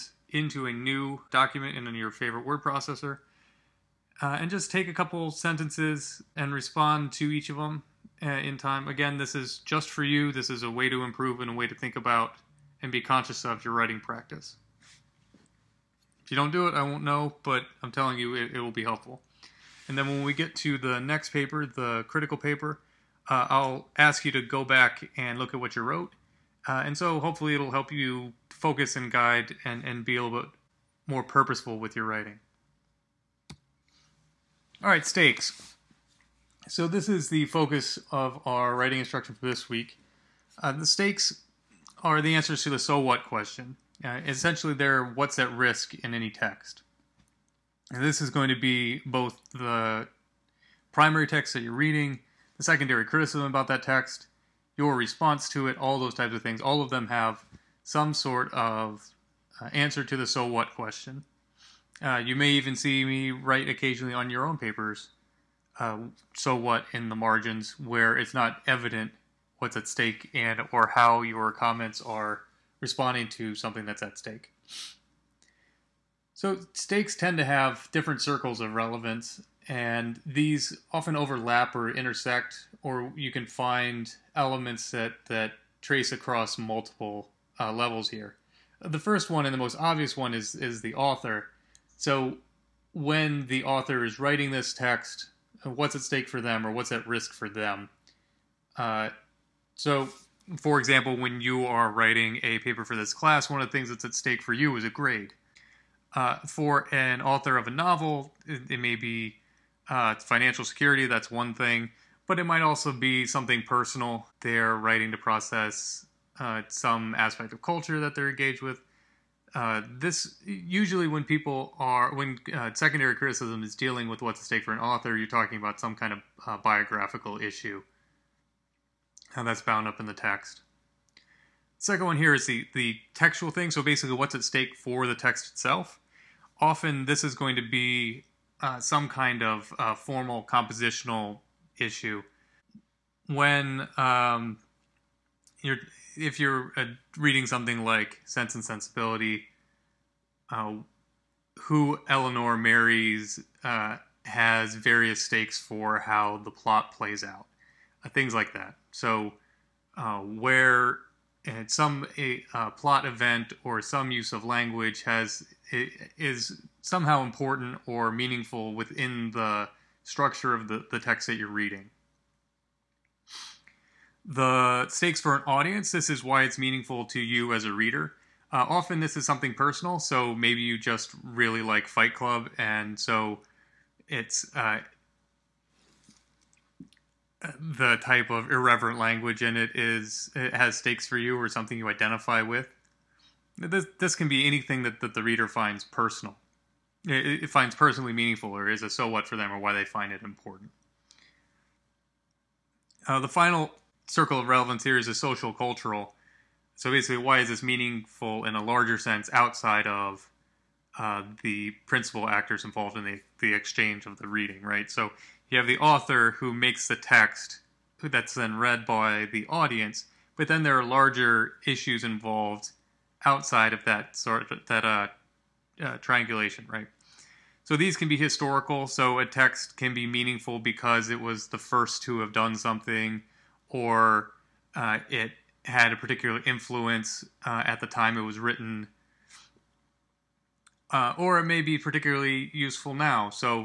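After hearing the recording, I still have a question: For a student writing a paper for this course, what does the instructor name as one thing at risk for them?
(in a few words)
A grade.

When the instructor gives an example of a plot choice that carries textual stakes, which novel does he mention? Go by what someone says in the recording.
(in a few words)
Sense and Sensibility.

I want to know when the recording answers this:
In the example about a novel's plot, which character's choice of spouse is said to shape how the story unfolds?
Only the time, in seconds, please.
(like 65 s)
152 s.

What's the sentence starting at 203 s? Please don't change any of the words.
Uh, the final circle of relevance here is a social cultural.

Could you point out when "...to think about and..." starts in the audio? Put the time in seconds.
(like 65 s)
11 s.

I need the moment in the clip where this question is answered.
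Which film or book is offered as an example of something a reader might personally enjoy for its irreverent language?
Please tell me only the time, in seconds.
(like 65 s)
181 s.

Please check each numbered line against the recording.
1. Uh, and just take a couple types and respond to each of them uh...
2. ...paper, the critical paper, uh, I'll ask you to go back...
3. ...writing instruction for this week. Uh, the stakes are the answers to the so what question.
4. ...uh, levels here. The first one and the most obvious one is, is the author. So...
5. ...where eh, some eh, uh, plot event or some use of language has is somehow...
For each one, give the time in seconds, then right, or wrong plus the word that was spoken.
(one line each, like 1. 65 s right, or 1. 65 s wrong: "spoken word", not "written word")
1. 4 s wrong: "sentences", not "types"
2. 21 s right
3. 38 s right
4. 87 s right
5. 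160 s right.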